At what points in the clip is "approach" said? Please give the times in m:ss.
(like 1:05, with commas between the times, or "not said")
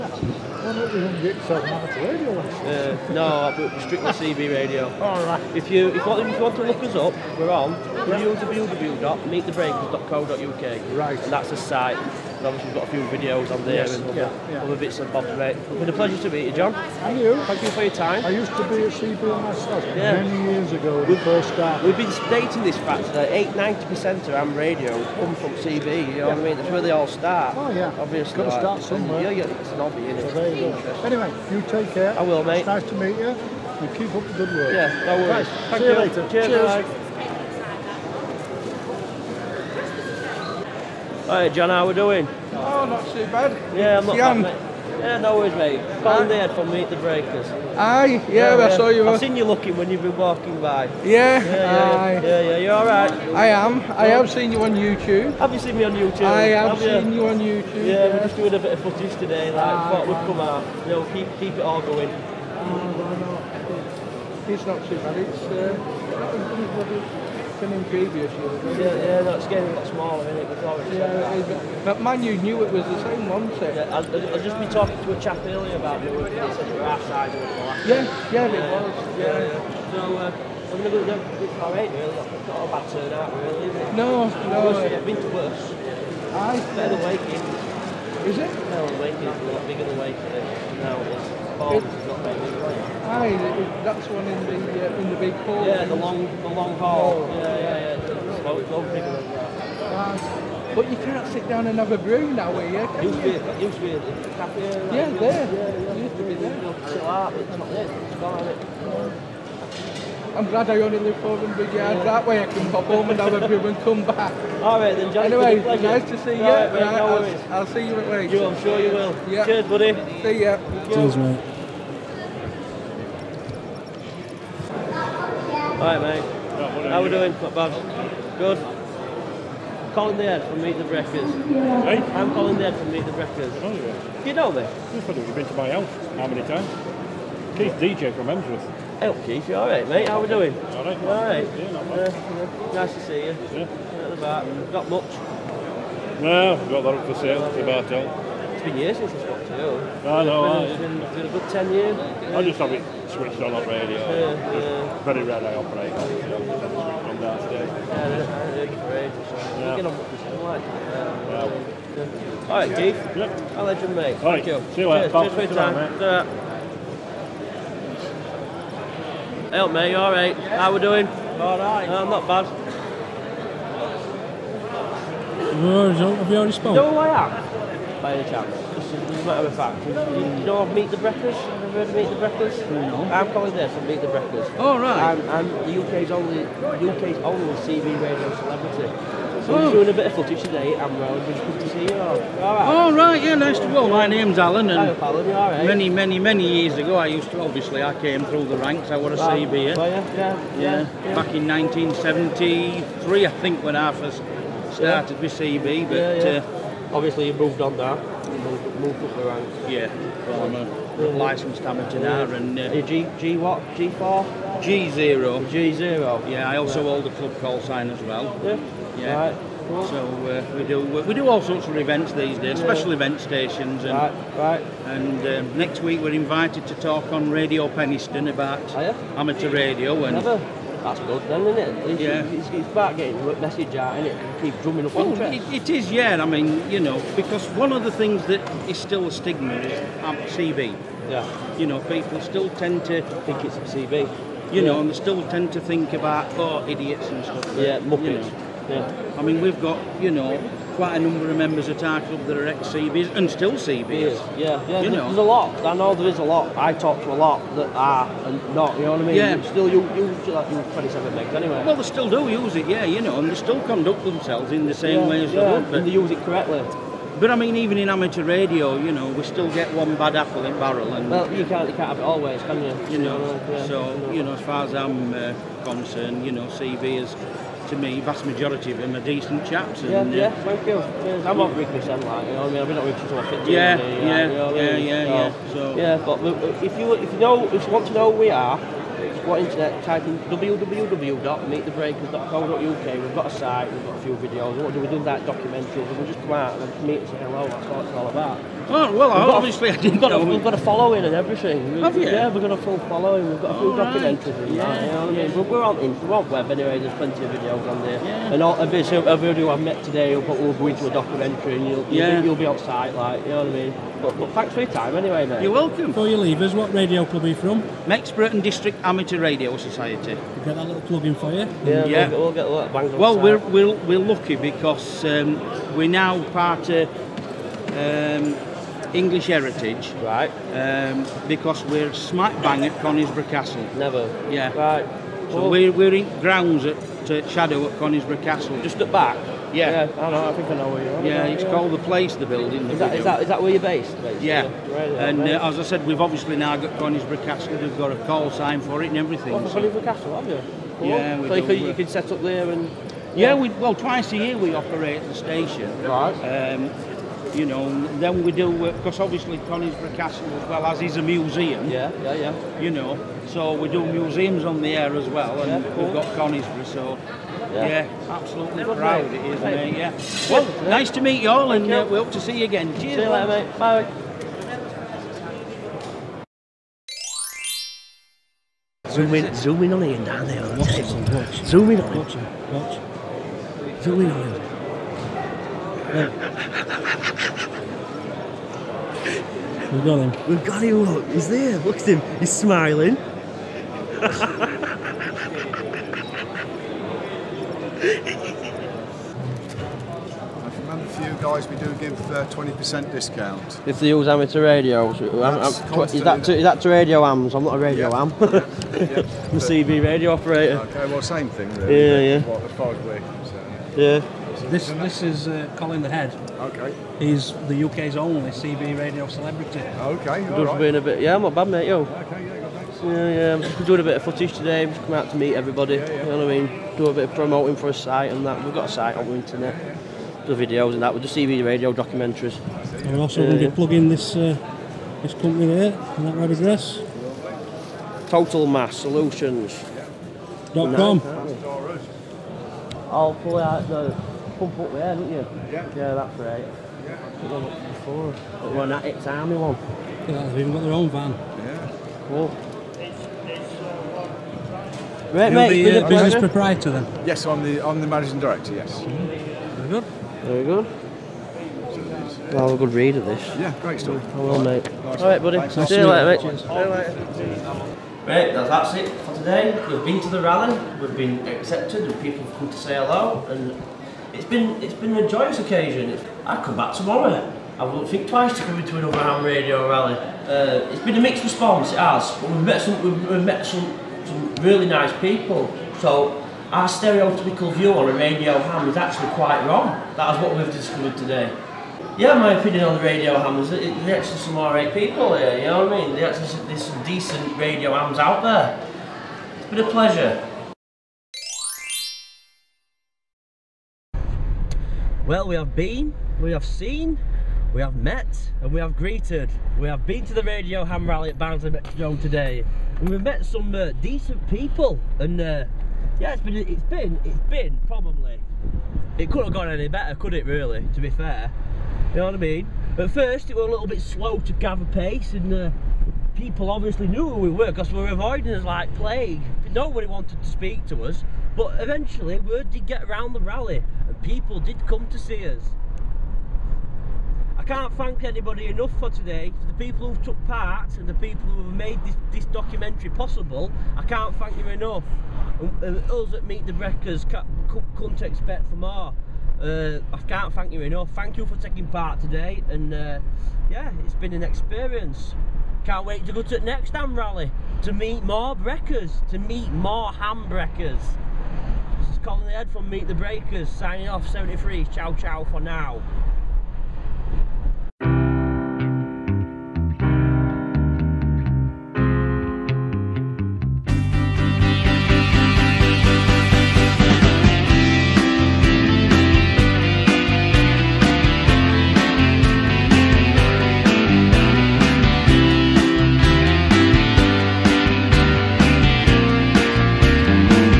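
not said.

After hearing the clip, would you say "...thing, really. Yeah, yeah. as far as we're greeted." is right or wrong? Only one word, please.
wrong.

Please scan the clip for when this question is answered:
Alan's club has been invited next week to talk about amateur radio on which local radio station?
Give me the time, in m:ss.
3:47.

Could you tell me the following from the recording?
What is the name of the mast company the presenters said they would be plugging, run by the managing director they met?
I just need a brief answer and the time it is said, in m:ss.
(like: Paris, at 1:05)
Total Mast Solutions, at 7:18.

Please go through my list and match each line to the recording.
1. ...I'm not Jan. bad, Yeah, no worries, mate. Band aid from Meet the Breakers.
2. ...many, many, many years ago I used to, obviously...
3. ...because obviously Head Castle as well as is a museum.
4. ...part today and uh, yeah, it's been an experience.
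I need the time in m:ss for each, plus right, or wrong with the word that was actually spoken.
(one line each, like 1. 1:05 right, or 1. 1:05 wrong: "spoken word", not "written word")
1. 0:43 right
2. 3:15 right
3. 5:58 wrong: "Conisbrough", not "Head"
4. 9:11 right.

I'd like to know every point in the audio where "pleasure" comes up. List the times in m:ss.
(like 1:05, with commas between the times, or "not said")
0:15, 8:19.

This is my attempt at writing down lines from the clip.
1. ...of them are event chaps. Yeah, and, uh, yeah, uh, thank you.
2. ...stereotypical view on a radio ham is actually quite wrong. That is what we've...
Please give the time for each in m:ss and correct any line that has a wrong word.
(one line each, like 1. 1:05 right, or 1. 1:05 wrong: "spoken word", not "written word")
1. 4:38 wrong: "decent", not "event"
2. 8:06 right.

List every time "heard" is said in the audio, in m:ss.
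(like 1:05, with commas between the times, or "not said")
2:37, 3:01.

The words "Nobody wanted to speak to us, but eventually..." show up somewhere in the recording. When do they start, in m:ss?
8:49.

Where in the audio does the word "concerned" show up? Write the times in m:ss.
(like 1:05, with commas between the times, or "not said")
4:35, 6:52.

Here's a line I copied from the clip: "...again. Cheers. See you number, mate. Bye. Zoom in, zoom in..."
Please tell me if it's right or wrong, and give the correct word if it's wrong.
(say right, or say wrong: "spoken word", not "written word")
wrong: "later", not "number".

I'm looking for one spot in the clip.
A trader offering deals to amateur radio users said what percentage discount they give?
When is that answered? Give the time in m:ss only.
6:41.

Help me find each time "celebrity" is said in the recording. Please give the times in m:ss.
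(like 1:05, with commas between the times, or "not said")
3:08, 6:59.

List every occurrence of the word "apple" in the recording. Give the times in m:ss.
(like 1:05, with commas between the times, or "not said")
4:30.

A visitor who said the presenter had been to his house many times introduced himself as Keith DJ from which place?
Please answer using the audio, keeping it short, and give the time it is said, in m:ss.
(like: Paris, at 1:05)
Emsworth, at 2:18.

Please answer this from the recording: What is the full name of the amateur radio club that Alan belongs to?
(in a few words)
Mexborough and District Amateur Radio Society.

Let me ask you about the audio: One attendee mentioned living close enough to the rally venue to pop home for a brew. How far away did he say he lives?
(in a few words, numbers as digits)
400 yards.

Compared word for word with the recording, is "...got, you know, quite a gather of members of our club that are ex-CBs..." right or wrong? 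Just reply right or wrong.
wrong.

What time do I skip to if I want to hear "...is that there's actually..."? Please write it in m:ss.
8:13.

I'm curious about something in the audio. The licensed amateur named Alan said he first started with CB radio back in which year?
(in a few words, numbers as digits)
1973.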